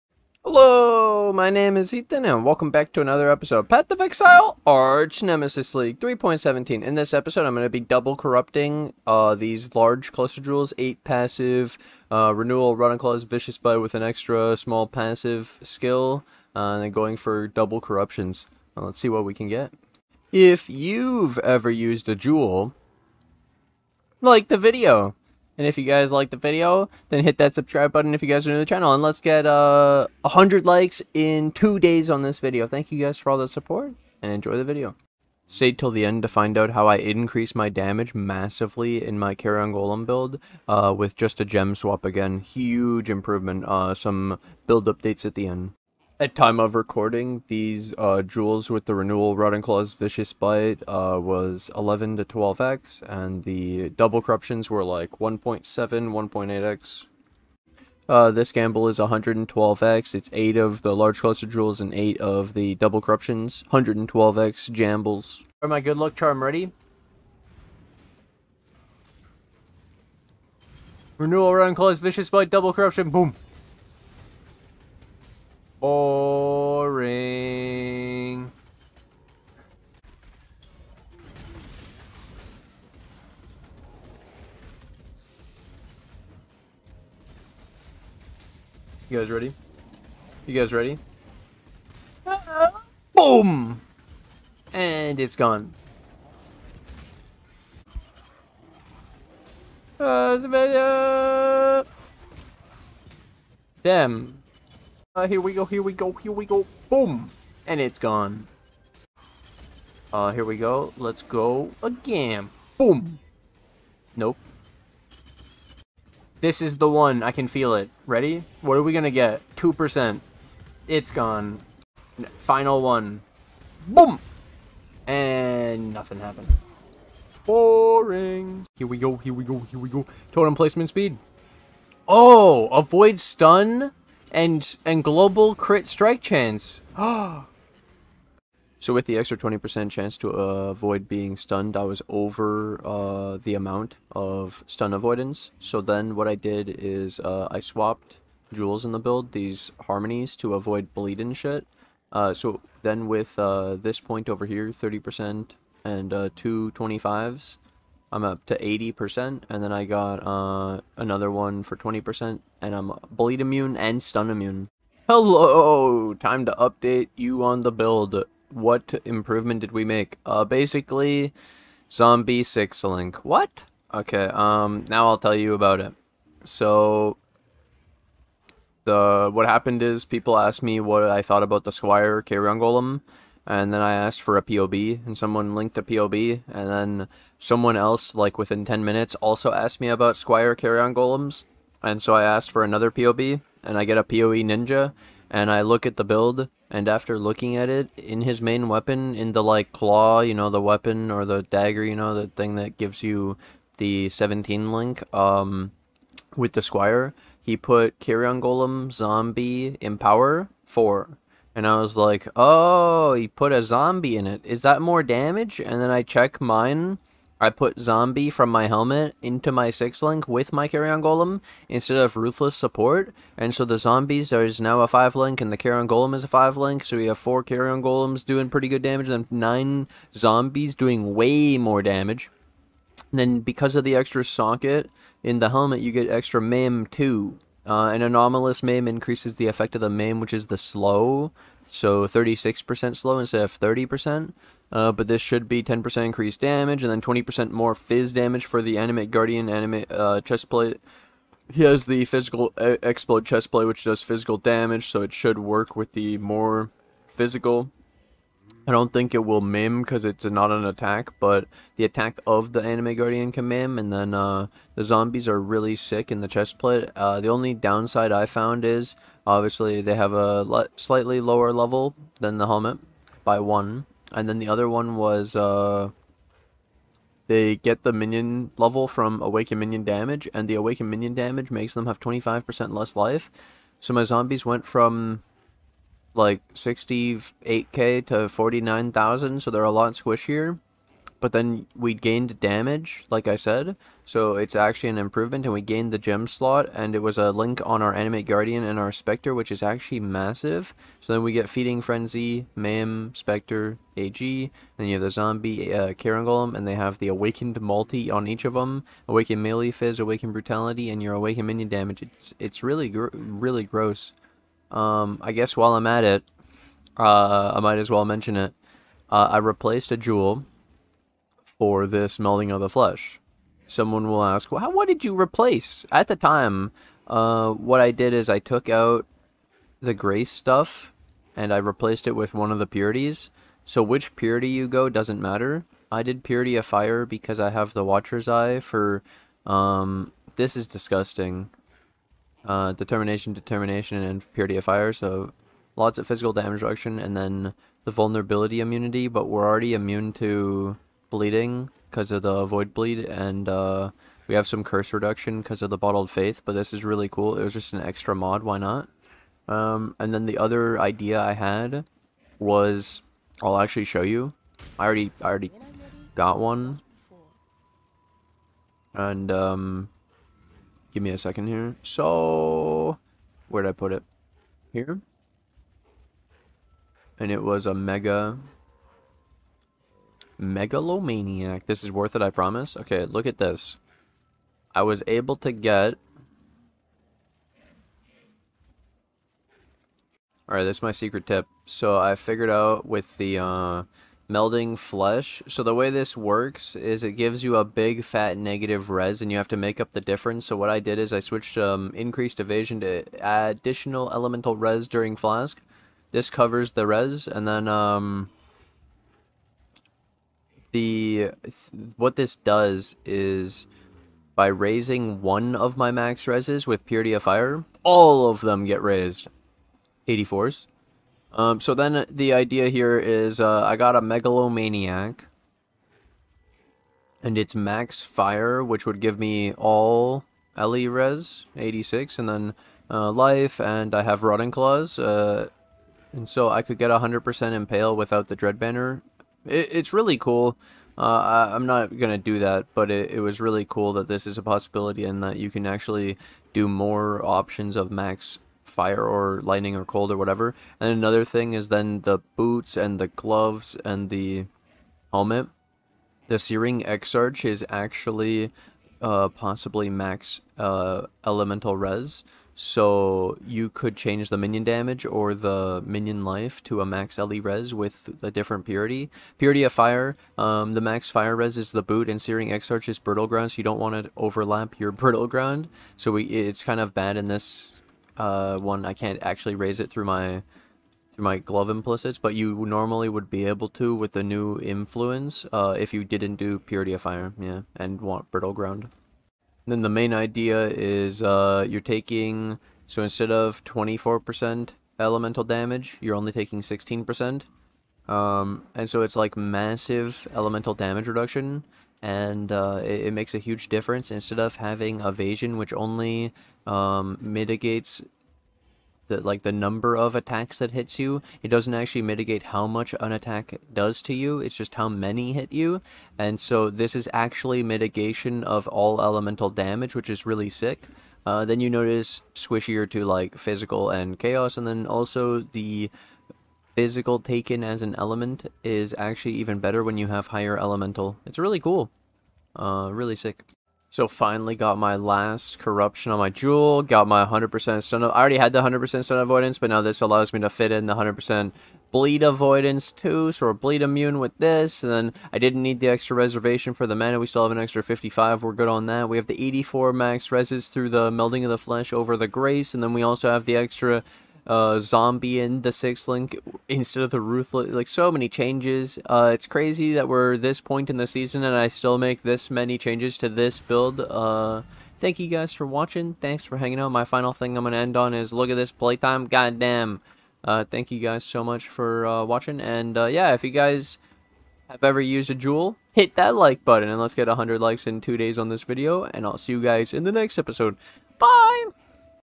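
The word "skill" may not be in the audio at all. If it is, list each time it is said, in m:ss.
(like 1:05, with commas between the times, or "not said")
0:15.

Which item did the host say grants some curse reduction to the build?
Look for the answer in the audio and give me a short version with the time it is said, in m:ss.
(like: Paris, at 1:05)
bottled faith, at 5:55.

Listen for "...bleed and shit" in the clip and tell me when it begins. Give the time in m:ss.
2:30.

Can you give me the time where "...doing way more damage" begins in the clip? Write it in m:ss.
3:50.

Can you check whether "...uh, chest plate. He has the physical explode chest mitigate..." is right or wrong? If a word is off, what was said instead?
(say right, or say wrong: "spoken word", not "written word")
wrong: "plate", not "mitigate".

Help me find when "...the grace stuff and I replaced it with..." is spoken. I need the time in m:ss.
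5:29.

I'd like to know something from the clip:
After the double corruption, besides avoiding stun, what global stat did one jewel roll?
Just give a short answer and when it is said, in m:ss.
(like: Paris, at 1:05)
global crit strike chance, at 2:15.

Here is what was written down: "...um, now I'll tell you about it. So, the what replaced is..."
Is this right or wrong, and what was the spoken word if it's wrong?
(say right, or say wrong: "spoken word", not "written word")
wrong: "happened", not "replaced".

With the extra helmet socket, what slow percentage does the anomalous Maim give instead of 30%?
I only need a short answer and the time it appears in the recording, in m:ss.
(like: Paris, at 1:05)
36%, at 4:02.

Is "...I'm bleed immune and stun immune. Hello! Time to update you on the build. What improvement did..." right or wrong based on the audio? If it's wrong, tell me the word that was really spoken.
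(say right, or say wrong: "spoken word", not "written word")
right.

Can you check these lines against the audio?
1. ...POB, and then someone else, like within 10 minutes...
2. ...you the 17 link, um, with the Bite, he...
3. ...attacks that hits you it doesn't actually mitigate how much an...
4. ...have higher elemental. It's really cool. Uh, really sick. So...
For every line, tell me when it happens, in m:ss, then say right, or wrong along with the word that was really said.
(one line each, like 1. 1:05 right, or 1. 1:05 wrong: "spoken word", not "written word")
1. 3:05 right
2. 3:23 wrong: "Squire", not "Bite"
3. 8:30 right
4. 8:50 right.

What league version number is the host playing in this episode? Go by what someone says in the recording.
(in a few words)
3.17.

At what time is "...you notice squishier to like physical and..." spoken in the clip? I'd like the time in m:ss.
8:41.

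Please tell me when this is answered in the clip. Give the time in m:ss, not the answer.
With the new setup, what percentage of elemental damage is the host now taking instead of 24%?
8:16.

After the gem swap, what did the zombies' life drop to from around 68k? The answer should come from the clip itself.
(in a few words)
49,000.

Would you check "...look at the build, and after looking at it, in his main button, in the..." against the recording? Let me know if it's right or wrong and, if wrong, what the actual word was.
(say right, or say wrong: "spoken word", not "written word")
wrong: "weapon", not "button".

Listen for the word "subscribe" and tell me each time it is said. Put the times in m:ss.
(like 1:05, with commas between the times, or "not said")
0:27.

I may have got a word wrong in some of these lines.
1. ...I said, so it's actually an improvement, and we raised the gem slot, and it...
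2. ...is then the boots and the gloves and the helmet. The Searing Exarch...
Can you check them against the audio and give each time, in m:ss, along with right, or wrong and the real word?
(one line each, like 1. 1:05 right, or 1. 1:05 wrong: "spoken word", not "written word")
1. 4:53 wrong: "gained", not "raised"
2. 7:31 right.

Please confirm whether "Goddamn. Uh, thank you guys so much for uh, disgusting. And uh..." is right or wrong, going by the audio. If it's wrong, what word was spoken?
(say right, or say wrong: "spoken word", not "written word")
wrong: "watching", not "disgusting".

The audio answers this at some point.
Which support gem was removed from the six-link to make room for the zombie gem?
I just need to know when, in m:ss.
3:42.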